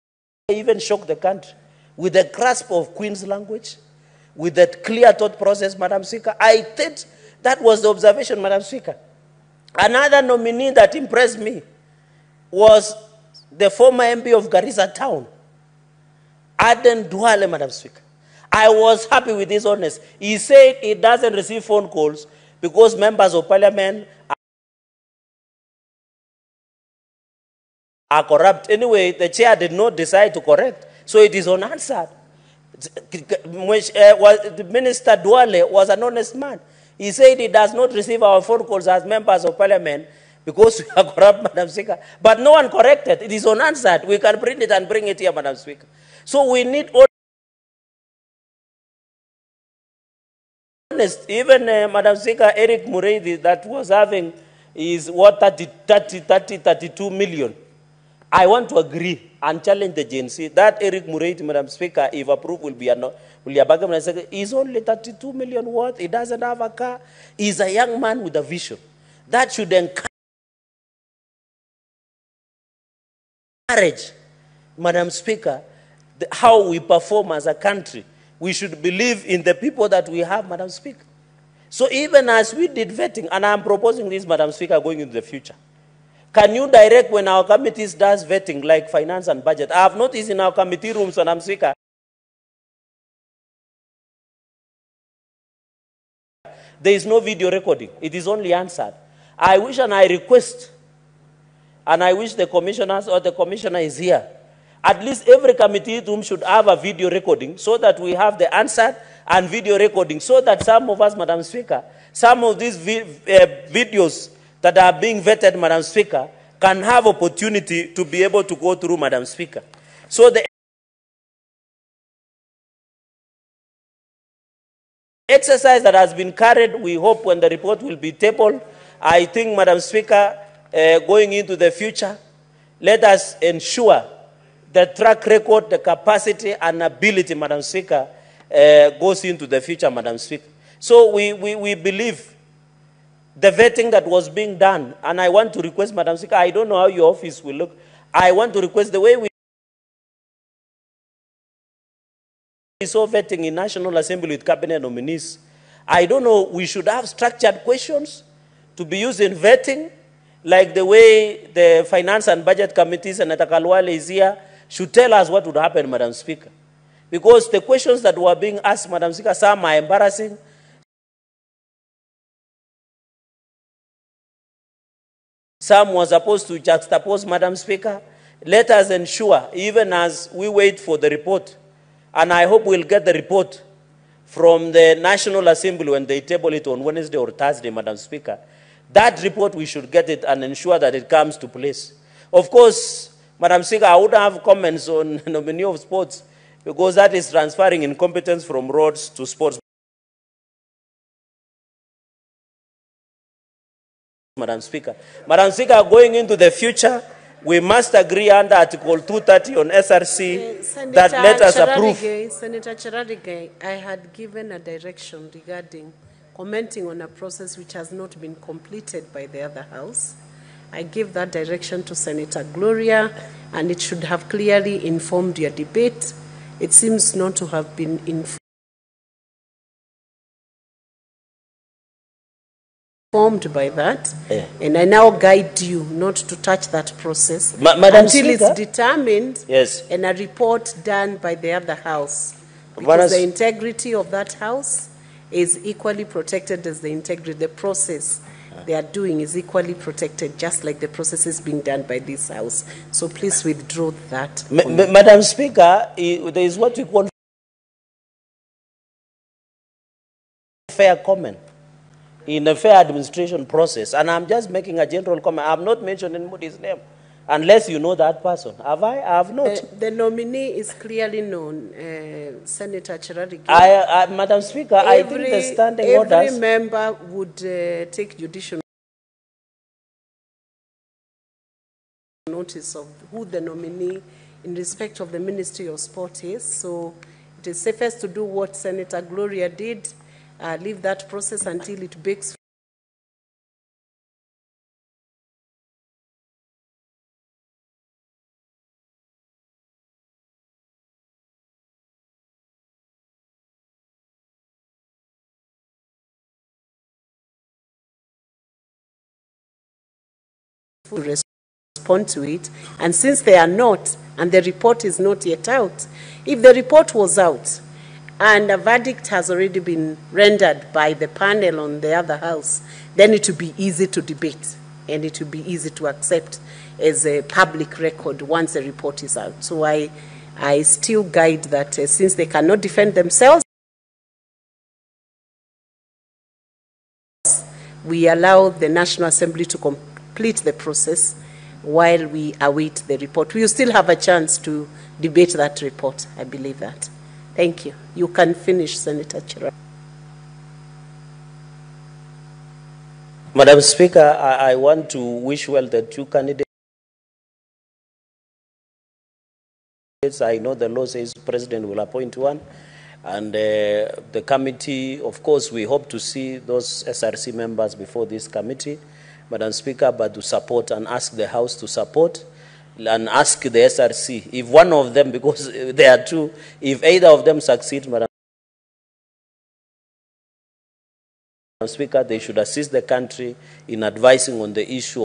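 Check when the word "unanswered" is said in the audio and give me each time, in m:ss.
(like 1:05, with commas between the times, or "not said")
0:31, 0:43.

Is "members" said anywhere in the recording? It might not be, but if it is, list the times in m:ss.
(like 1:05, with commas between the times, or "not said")
0:22, 0:39, 4:36, 6:07.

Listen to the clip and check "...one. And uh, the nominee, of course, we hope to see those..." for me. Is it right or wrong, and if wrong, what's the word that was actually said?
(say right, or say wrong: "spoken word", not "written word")
wrong: "committee", not "nominee".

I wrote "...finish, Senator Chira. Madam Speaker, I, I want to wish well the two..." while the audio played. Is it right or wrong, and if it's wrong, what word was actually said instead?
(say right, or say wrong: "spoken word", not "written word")
right.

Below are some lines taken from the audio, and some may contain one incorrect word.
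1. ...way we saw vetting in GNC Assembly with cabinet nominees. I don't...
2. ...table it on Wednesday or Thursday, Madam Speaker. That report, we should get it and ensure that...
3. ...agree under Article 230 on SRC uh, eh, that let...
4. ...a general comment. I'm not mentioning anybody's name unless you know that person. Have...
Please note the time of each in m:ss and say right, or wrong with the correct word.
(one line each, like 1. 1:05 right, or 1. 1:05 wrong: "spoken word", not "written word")
1. 2:28 wrong: "National", not "GNC"
2. 3:06 right
3. 3:27 right
4. 4:24 right.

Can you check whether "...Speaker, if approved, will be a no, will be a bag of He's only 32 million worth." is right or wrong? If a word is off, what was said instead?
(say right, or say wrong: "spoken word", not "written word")
right.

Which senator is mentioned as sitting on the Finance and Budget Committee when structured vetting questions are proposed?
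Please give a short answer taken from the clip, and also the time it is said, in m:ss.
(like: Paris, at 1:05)
Khalwale, at 2:43.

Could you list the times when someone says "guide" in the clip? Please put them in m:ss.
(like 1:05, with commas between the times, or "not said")
3:55, 5:31.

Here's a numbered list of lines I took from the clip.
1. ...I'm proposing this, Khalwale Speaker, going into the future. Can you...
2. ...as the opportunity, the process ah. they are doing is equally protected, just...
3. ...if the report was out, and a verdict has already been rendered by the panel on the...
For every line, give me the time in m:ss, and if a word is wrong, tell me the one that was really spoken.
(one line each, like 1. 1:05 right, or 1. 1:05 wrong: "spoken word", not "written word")
1. 1:23 wrong: "Madam", not "Khalwale"
2. 4:06 wrong: "integrity", not "opportunity"
3. 5:16 right.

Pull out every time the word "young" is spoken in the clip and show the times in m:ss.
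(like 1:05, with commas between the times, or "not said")
1:07.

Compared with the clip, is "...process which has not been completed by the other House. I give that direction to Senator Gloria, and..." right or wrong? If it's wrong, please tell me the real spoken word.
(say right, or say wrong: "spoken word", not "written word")
right.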